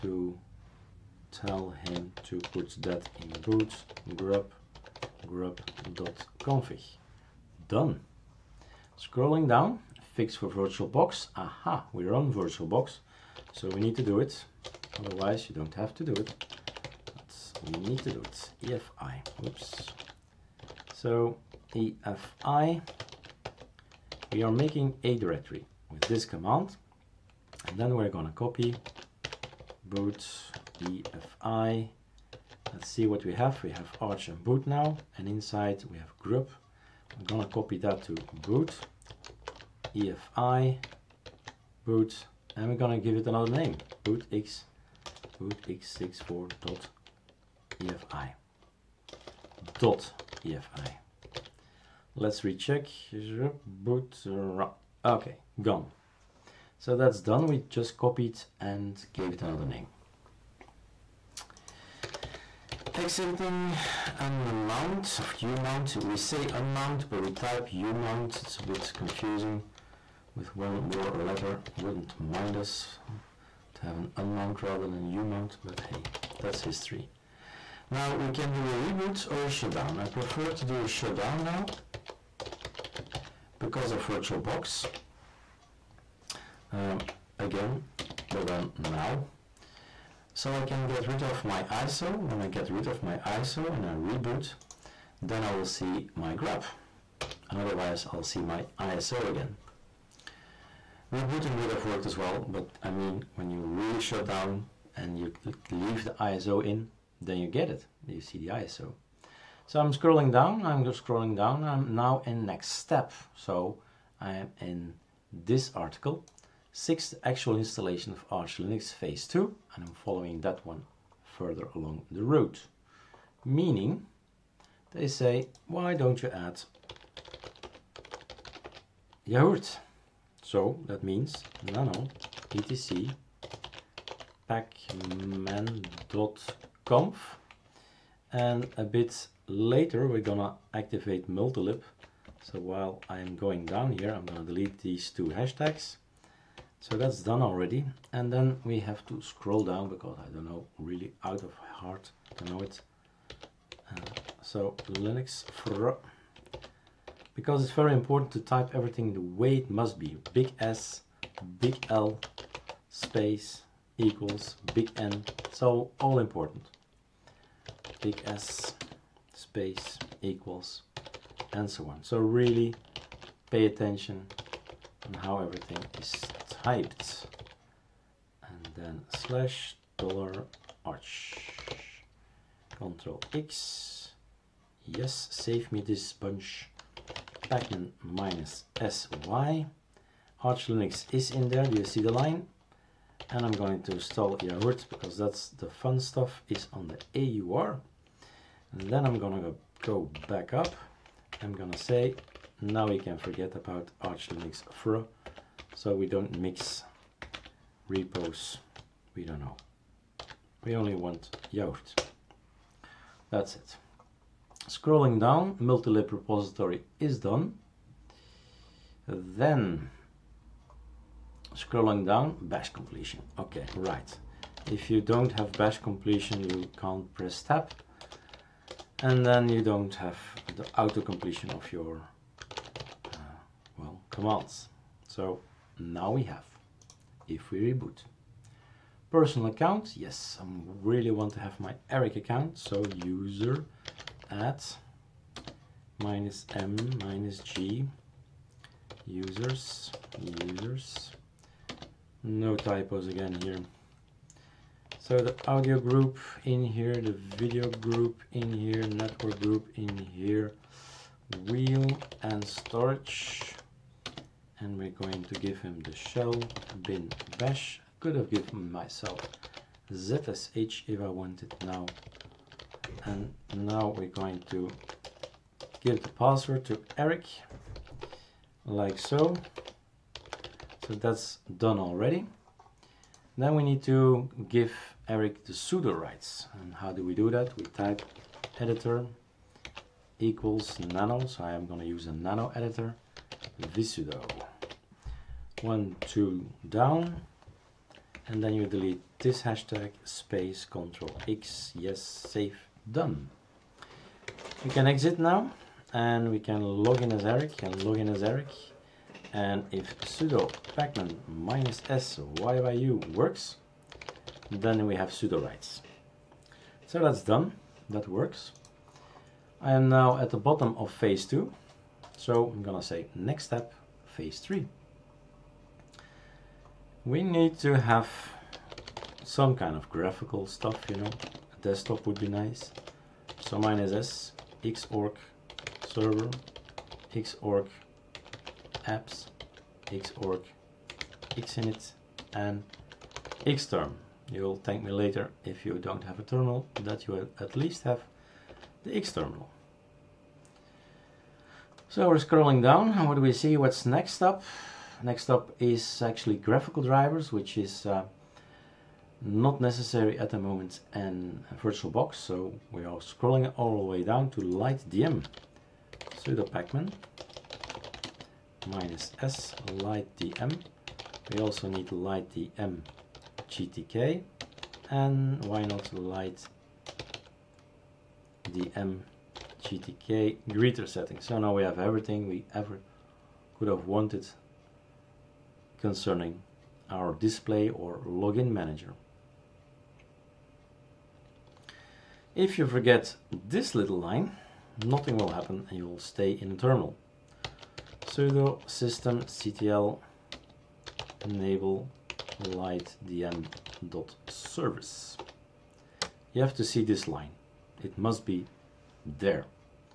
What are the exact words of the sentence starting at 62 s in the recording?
Exiting an mount of U mount.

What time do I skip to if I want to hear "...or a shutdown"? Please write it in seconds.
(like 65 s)
79 s.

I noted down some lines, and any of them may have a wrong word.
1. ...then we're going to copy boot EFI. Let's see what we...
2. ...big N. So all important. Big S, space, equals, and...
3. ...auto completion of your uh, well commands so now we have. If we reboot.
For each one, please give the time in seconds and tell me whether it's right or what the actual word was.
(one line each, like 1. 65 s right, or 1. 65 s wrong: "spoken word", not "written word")
1. 27 s right
2. 164 s right
3. 230 s right.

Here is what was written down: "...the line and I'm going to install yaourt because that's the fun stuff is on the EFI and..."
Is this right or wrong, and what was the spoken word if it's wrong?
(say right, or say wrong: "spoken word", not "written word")
wrong: "AUR", not "EFI".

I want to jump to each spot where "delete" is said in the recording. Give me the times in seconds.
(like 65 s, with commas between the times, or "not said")
144 s, 298 s.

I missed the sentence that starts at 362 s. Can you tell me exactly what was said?
So we are scrolling all the way down to LightDM, sudo pacman minus s lightdm.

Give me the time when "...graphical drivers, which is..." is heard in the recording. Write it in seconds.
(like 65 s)
356 s.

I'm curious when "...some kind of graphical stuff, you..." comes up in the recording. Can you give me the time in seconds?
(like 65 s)
329 s.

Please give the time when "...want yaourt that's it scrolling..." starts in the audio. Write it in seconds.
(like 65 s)
210 s.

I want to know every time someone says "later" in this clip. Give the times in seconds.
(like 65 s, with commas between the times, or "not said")
139 s, 344 s.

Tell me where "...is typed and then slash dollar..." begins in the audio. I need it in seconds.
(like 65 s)
176 s.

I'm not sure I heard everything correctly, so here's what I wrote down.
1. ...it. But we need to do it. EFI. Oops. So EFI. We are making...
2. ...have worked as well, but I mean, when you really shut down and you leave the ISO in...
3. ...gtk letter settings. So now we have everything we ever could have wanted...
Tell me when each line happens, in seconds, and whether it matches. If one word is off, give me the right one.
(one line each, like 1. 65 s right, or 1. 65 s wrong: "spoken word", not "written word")
1. 16 s right
2. 101 s right
3. 378 s wrong: "greeter", not "letter".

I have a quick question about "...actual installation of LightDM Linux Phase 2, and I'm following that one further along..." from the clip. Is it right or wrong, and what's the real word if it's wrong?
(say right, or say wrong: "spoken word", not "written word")
wrong: "Arch", not "LightDM".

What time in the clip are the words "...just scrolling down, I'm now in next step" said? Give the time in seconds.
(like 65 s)
110 s.